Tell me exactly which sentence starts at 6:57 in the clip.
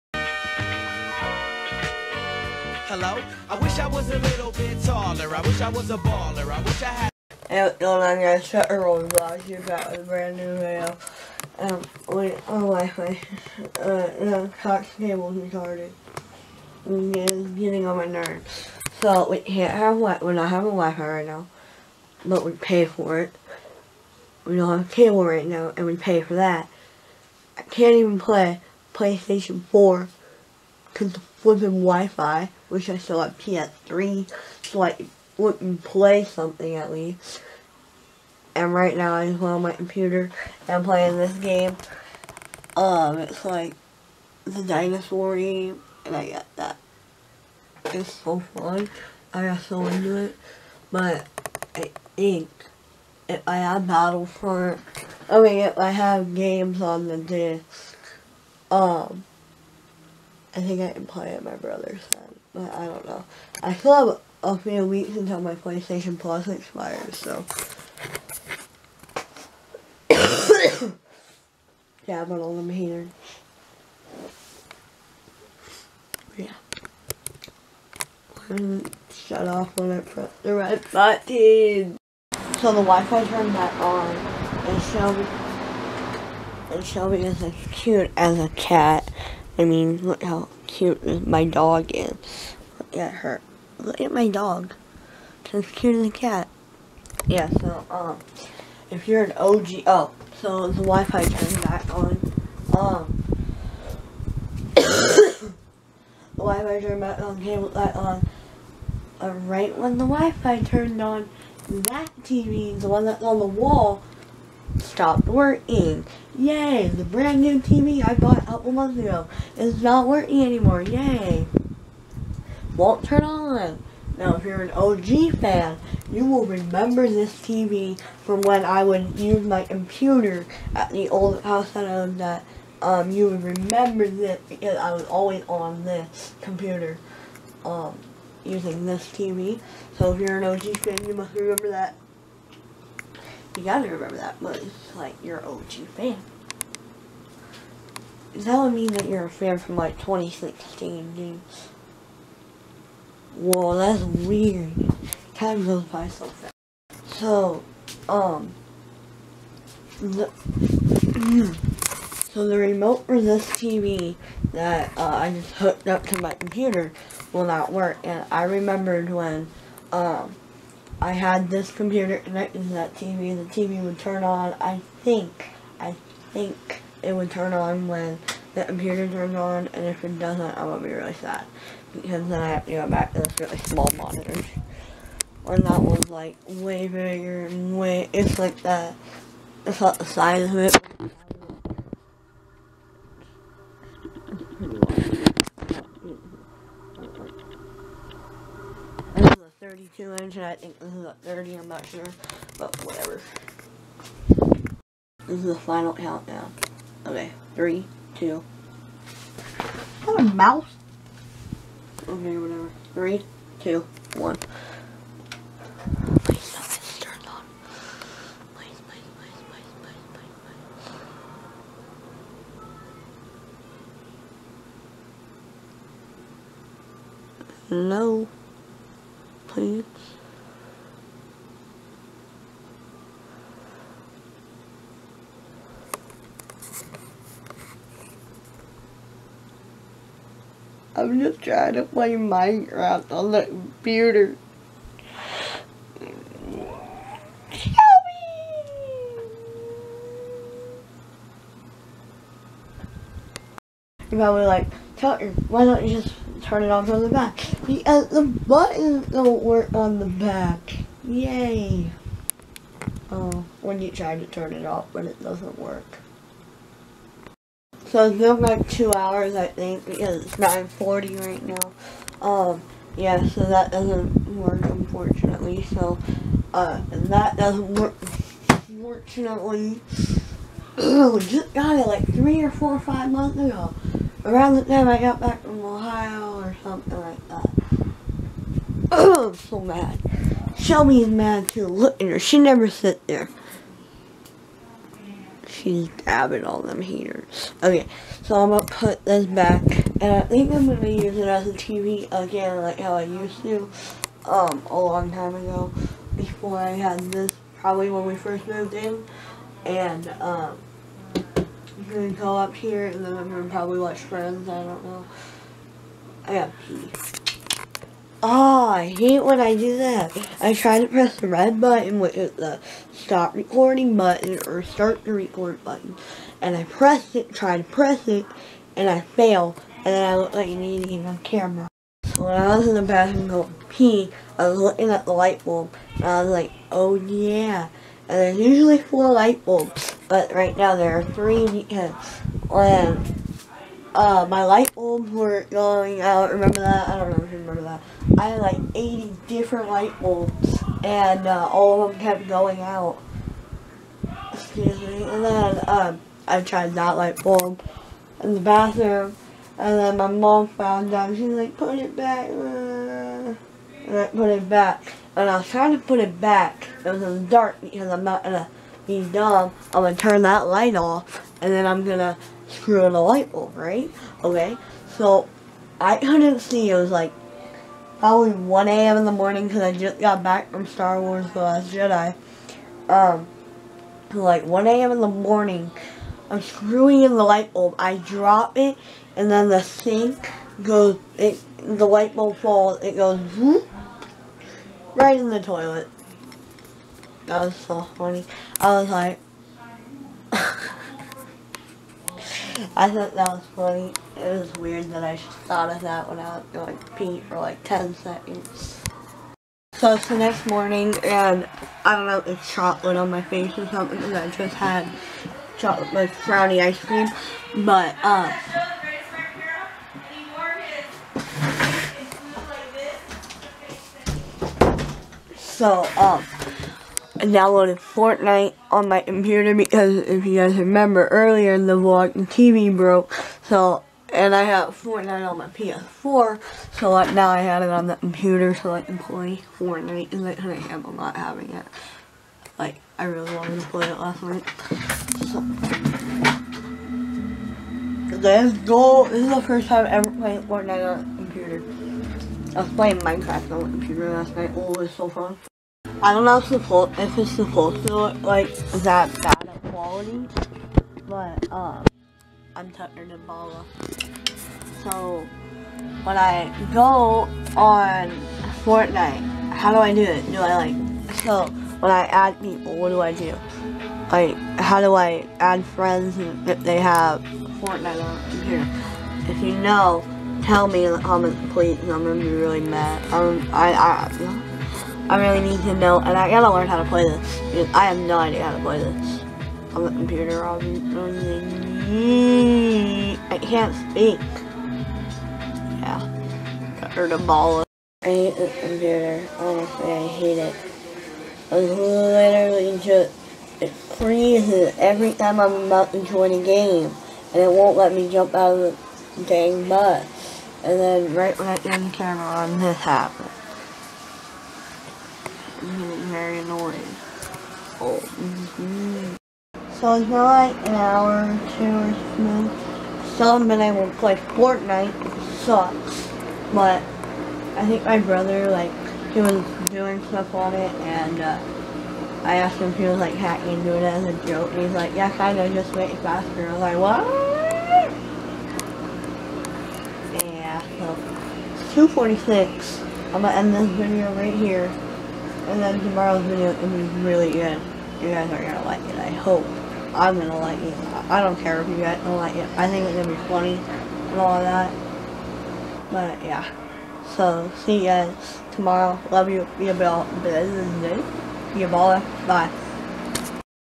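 But, uh, so, um, I downloaded Fortnite on my computer because if you guys remember earlier in the vlog, the TV broke.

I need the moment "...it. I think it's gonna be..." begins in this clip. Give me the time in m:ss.
9:12.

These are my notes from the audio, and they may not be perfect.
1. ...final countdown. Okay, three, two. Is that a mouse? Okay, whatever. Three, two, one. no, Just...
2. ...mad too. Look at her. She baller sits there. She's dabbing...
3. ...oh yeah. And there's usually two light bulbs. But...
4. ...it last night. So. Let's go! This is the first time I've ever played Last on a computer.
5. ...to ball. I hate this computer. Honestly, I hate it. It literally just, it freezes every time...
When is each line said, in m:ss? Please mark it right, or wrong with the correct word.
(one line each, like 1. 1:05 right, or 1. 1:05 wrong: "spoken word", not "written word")
1. 3:25 wrong: "Please", not "Just"
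2. 4:51 wrong: "never", not "baller"
3. 5:36 wrong: "four", not "two"
4. 7:23 wrong: "Fortnite", not "Last"
5. 8:17 right.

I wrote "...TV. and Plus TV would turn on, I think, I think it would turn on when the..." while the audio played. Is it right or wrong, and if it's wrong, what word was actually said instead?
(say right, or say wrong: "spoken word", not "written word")
wrong: "The", not "Plus".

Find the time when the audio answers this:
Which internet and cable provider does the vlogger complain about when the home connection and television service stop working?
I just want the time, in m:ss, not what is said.
0:14.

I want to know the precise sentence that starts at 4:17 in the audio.
The, uh, the buttons don't work on the back.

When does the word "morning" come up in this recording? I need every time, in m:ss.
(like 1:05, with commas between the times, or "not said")
6:19, 6:25, 6:50.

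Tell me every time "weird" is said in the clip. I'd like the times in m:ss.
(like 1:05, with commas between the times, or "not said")
2:34, 6:44.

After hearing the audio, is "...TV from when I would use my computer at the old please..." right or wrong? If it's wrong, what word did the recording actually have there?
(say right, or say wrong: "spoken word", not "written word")
wrong: "house", not "please".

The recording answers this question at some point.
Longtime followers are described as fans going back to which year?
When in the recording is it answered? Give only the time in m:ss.
2:29.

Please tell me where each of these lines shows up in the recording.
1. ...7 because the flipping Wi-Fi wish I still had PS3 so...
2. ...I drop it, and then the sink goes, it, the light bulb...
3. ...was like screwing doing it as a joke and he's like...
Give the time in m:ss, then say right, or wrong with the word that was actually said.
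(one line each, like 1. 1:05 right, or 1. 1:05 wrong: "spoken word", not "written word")
1. 0:29 wrong: "4", not "7"
2. 6:27 right
3. 8:52 wrong: "hacking", not "screwing".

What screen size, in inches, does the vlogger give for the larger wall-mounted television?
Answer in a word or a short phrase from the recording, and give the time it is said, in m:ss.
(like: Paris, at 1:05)
32 inch, at 3:19.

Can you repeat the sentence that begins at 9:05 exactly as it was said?
And then tomorrow's video is really good.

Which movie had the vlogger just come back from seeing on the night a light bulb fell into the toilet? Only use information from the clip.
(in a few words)
Star Wars The Last Jedi.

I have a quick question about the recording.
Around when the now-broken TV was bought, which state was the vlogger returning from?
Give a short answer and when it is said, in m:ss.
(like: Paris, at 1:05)
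Ohio, at 4:45.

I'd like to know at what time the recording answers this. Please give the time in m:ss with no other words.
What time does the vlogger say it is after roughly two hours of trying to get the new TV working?
4:30.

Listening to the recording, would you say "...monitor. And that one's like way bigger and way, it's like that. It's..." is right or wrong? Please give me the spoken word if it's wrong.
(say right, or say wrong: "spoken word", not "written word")
right.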